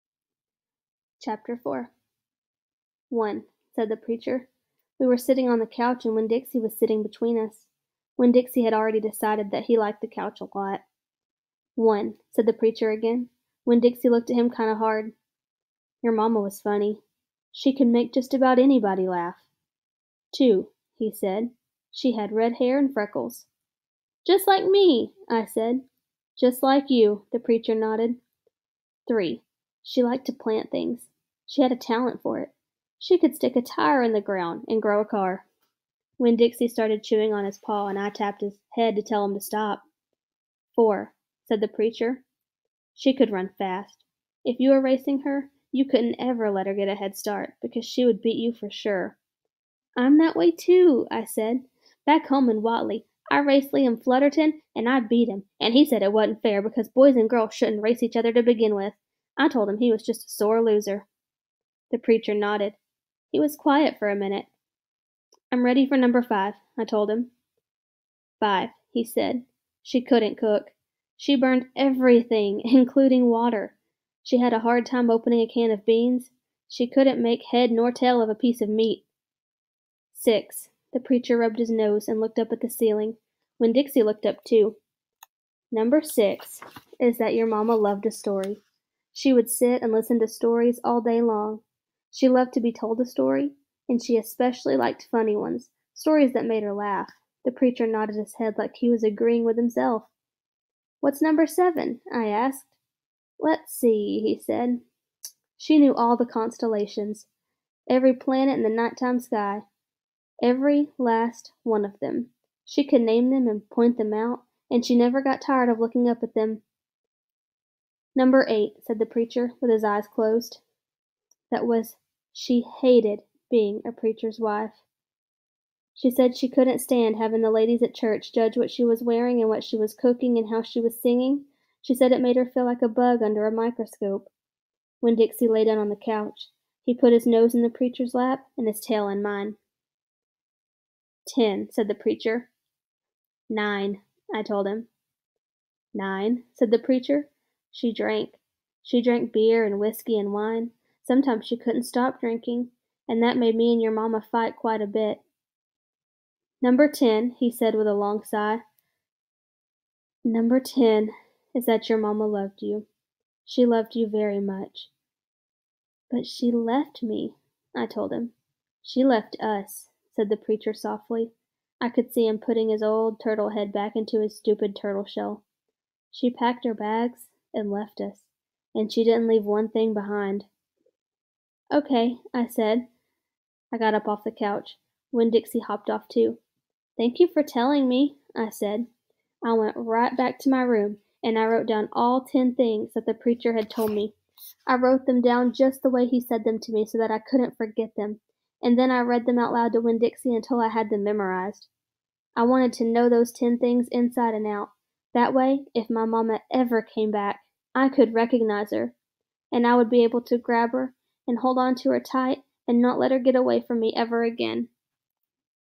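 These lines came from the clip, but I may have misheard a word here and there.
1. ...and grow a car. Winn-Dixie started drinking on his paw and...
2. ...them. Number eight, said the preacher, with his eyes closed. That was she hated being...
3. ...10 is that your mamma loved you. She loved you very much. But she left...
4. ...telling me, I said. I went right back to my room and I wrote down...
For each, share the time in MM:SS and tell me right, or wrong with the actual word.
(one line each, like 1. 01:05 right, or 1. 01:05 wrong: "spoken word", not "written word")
1. 00:34 wrong: "chewing", not "drinking"
2. 01:56 right
3. 02:40 right
4. 03:07 right.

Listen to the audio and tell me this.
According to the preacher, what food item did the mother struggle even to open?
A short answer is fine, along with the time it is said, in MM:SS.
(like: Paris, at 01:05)
A can of beans, at 01:15.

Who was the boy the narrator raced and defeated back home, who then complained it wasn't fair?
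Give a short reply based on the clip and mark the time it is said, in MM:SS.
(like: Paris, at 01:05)
Liam Flutterton, at 00:53.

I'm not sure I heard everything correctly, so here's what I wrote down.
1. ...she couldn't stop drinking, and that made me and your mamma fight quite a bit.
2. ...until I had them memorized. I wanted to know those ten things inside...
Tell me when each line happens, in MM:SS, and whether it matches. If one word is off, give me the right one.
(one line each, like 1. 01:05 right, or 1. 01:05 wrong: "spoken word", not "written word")
1. 02:31 right
2. 03:20 right.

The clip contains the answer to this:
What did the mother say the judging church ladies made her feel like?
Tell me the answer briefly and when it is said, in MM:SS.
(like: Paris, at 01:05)
A bug under a microscope, at 02:12.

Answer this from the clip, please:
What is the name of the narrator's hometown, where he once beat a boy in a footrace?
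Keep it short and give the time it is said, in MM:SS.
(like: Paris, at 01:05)
Watley, at 00:52.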